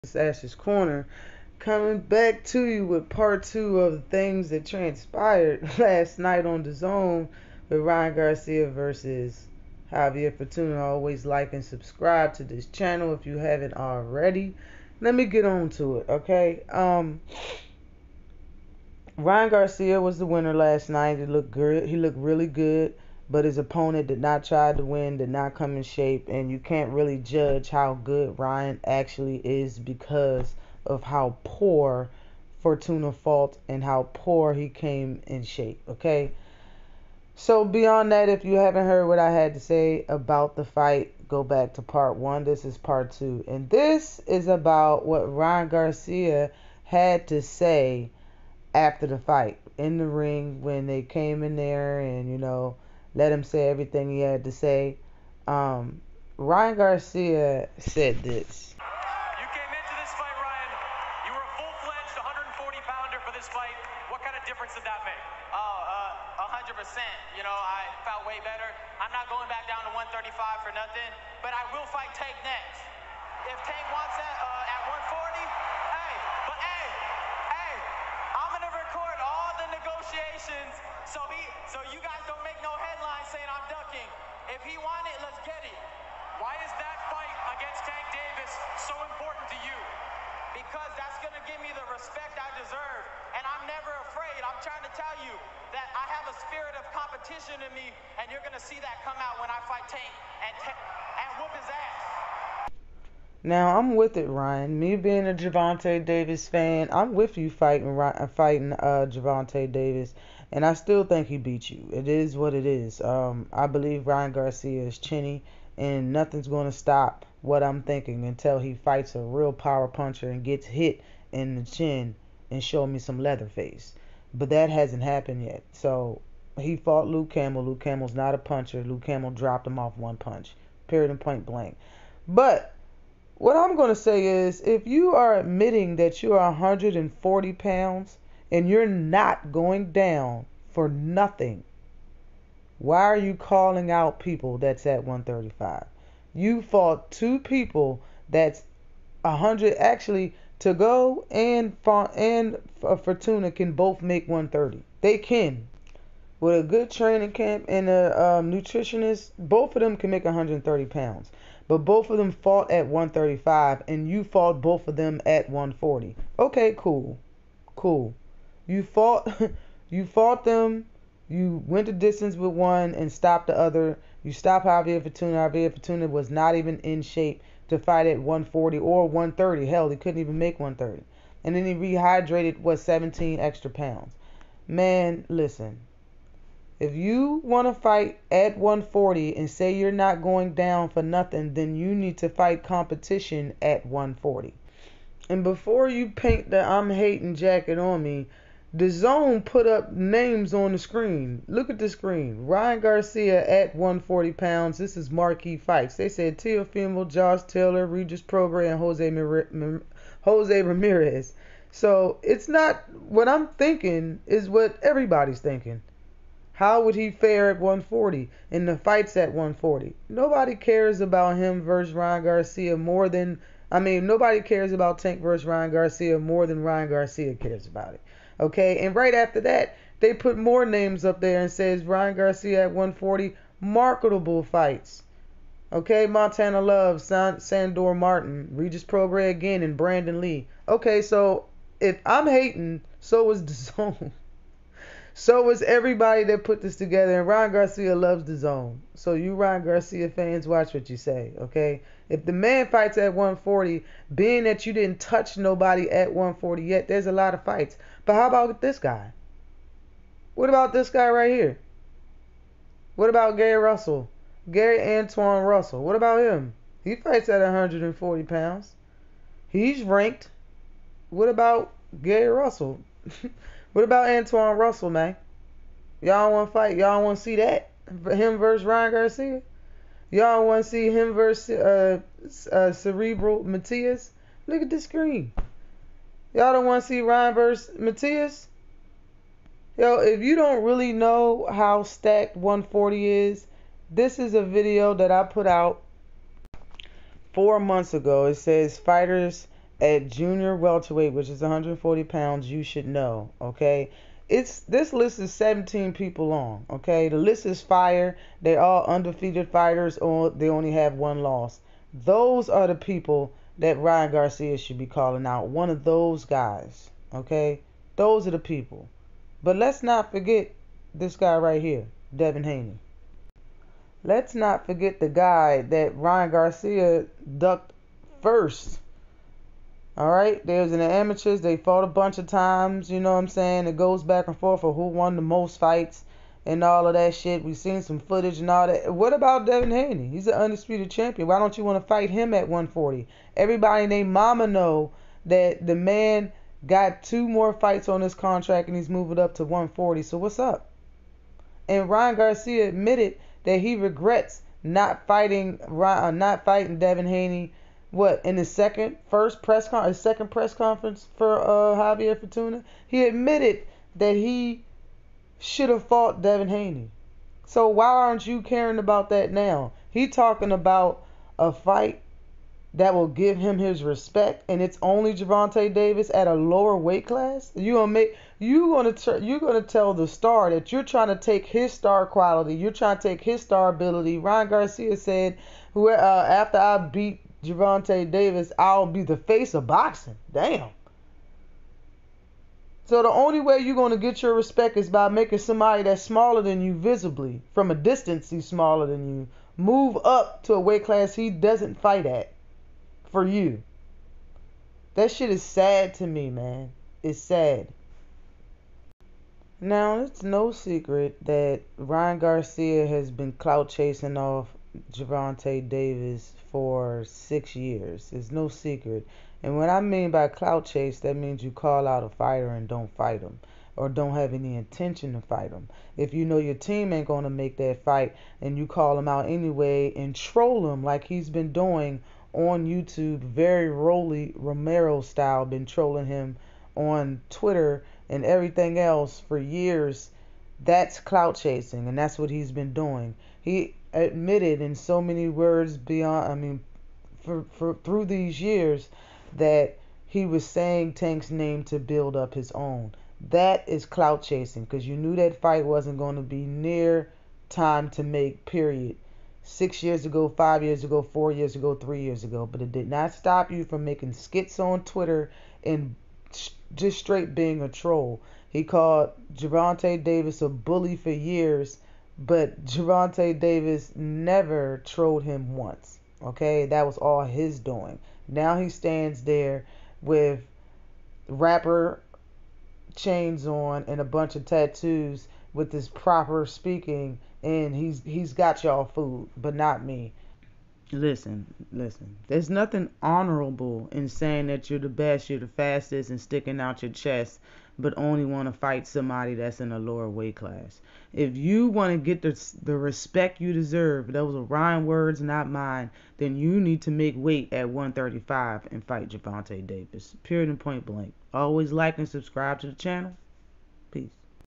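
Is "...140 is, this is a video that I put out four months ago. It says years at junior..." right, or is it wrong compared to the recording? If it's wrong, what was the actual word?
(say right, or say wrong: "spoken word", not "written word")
wrong: "fighters", not "years".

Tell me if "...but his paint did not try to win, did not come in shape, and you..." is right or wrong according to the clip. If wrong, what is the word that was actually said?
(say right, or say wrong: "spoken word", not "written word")
wrong: "opponent", not "paint".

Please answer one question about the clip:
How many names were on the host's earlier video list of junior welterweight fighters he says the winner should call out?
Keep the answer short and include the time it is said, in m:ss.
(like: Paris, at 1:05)
17, at 5:05.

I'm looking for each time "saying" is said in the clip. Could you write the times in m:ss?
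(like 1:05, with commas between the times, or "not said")
1:23, 5:33, 7:30, 8:14.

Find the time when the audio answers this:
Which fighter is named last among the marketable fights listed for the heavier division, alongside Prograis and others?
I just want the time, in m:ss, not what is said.
3:59.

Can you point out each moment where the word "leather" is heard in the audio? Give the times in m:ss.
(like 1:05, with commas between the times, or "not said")
2:03.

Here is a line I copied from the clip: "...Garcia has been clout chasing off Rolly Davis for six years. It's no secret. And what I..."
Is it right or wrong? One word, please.
wrong.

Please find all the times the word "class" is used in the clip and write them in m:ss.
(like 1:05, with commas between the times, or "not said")
6:17, 6:40, 8:20.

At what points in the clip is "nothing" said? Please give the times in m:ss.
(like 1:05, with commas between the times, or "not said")
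1:10, 1:56, 2:20, 3:11, 8:12.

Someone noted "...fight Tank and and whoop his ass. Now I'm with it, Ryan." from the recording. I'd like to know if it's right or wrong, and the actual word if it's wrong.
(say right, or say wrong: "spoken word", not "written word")
right.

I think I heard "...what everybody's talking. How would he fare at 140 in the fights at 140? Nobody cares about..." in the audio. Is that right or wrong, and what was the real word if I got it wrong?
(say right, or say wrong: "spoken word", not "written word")
wrong: "thinking", not "talking".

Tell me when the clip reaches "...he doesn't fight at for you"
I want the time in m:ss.
6:41.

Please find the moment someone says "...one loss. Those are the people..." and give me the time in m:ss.
5:10.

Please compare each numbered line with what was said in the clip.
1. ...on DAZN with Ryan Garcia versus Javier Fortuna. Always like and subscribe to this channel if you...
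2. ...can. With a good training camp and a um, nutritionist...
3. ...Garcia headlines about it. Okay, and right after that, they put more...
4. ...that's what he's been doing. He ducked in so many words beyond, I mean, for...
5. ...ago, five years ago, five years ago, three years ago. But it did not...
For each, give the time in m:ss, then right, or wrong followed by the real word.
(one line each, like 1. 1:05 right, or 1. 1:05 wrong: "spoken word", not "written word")
1. 0:06 right
2. 2:35 right
3. 3:46 wrong: "cares", not "headlines"
4. 7:21 wrong: "admitted", not "ducked"
5. 7:40 wrong: "four", not "five".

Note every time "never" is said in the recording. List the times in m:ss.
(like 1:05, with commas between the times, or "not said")
1:33, 7:53.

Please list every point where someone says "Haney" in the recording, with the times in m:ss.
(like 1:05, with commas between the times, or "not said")
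5:22, 5:39, 5:57, 6:06.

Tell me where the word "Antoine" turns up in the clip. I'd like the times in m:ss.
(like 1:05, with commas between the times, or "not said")
4:24, 4:34.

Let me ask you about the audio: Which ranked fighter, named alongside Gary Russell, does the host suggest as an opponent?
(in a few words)
Subriel Matias.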